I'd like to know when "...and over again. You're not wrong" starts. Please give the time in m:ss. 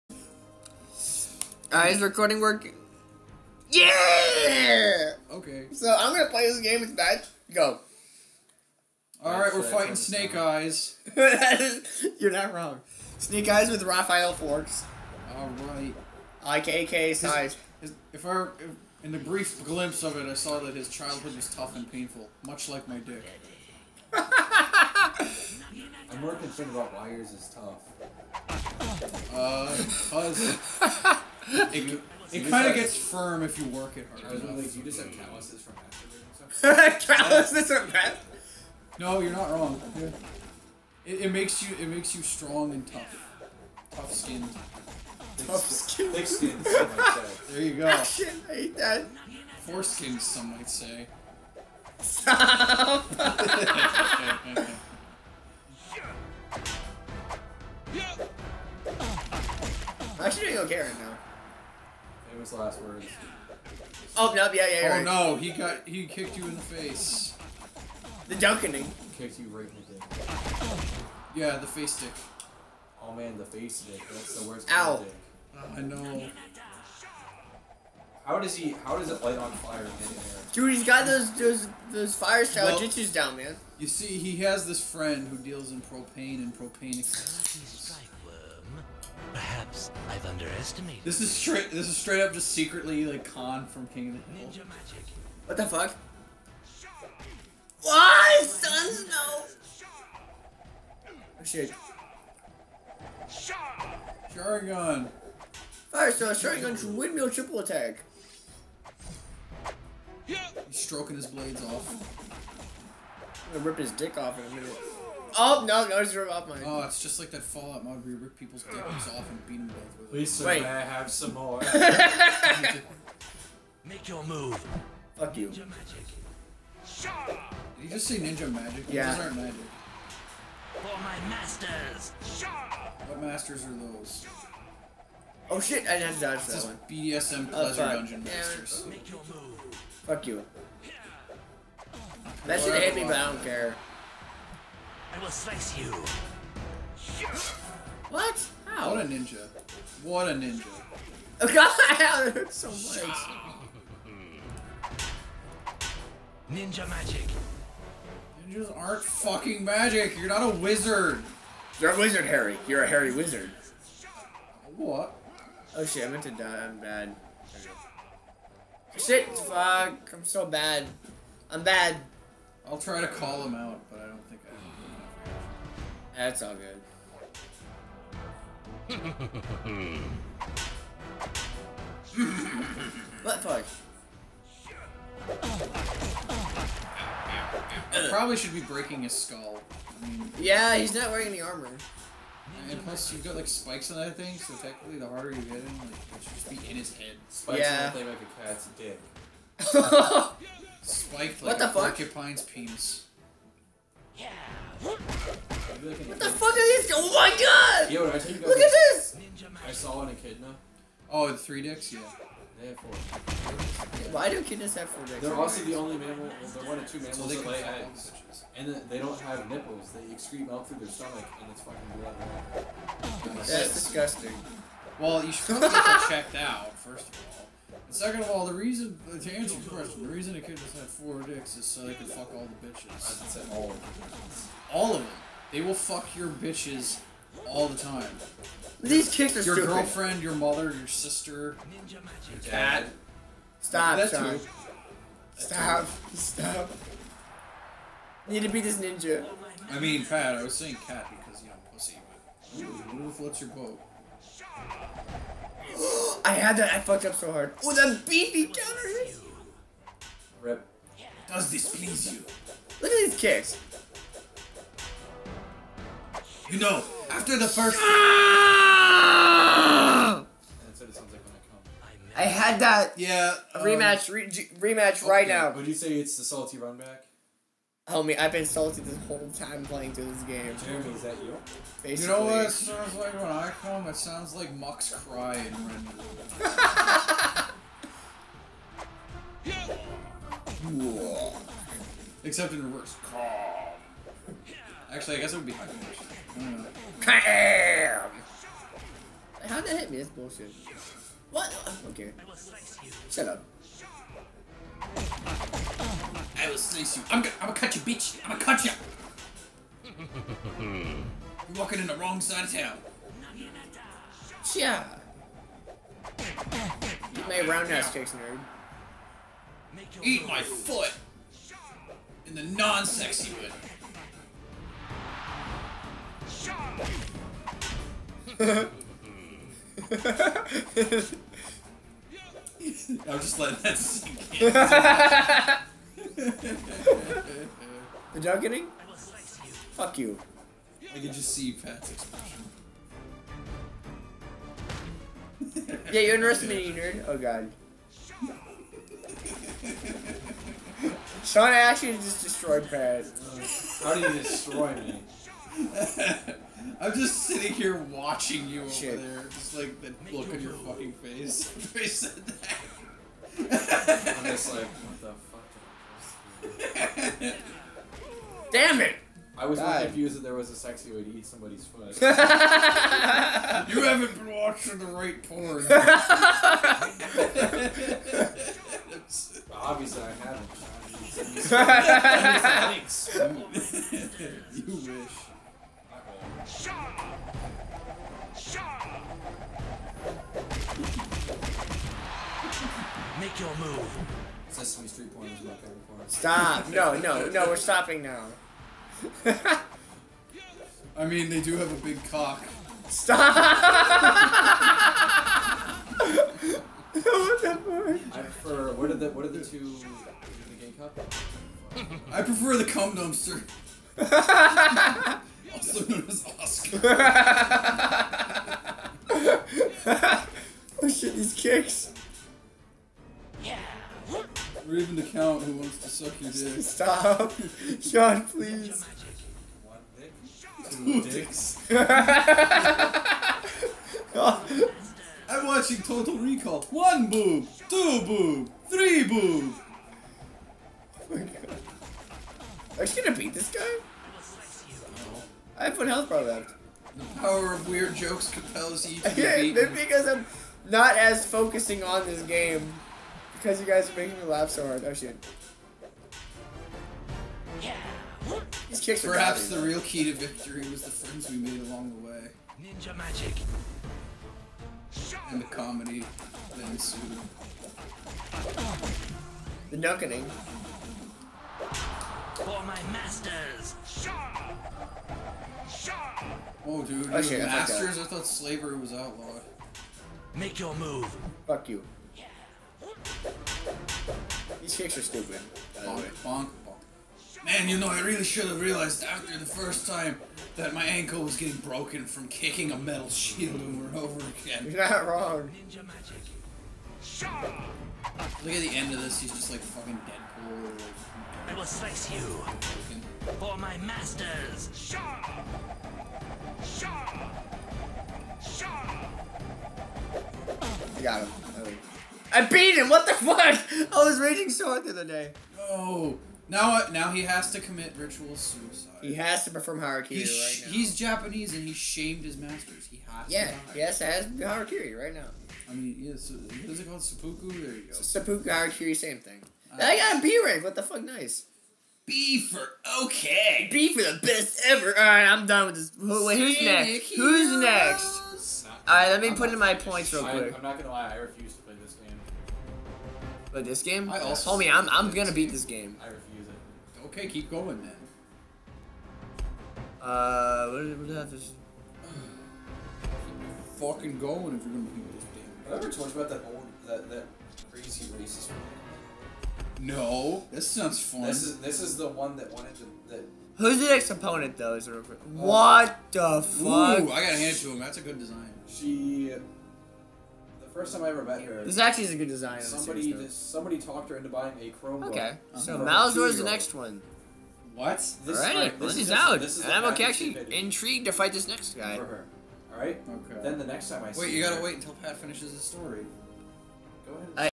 8:13.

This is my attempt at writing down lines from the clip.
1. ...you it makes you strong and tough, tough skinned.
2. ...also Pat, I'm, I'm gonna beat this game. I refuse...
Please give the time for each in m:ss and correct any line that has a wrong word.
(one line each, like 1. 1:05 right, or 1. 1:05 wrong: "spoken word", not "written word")
1. 0:41 right
2. 9:04 wrong: "Homie", not "Pat".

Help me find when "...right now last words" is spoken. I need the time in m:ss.
1:00.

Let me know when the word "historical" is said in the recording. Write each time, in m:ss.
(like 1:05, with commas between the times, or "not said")
not said.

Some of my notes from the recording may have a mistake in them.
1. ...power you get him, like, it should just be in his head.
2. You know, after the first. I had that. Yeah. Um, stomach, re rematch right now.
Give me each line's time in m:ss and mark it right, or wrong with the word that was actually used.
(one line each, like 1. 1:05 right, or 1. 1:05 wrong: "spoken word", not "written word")
1. 3:15 wrong: "harder", not "power"
2. 4:26 wrong: "rematch", not "stomach".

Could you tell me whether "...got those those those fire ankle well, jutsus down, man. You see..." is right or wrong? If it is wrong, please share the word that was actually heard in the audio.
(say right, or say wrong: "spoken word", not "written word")
wrong: "style", not "ankle".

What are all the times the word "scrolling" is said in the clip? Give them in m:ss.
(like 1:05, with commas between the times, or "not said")
not said.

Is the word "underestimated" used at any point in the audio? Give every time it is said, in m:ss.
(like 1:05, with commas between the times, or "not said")
1:30.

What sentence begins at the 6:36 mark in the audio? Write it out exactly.
No, no, no, we're stopping now.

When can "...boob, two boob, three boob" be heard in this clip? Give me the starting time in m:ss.
7:17.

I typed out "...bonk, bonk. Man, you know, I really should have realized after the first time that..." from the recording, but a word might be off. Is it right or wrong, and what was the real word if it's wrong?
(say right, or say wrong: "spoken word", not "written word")
right.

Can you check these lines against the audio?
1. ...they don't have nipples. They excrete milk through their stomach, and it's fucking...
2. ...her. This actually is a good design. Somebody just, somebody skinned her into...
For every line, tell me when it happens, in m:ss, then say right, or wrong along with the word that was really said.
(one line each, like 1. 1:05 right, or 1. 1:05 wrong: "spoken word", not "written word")
1. 3:38 right
2. 9:31 wrong: "talked", not "skinned".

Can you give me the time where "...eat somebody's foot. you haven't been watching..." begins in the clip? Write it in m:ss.
6:11.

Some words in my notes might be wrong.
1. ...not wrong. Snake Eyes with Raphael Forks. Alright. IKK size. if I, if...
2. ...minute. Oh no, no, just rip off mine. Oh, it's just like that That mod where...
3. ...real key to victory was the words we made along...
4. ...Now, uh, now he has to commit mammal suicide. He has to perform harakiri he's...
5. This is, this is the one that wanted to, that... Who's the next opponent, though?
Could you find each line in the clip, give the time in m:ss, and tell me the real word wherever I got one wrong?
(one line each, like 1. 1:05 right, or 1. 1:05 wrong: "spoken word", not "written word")
1. 0:12 right
2. 1:54 wrong: "Fallout", not "That"
3. 7:39 wrong: "friends", not "words"
4. 8:36 wrong: "ritual", not "mammal"
5. 9:21 right.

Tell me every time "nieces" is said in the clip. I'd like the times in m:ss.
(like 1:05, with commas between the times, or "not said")
not said.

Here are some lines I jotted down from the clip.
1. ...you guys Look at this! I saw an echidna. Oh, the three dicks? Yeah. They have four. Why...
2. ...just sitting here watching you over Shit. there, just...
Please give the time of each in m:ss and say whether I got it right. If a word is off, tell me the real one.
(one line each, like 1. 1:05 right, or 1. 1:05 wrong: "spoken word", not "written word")
1. 3:27 right
2. 5:56 right.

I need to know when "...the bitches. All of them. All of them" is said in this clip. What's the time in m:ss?
3:52.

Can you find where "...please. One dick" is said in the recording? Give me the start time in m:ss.
7:08.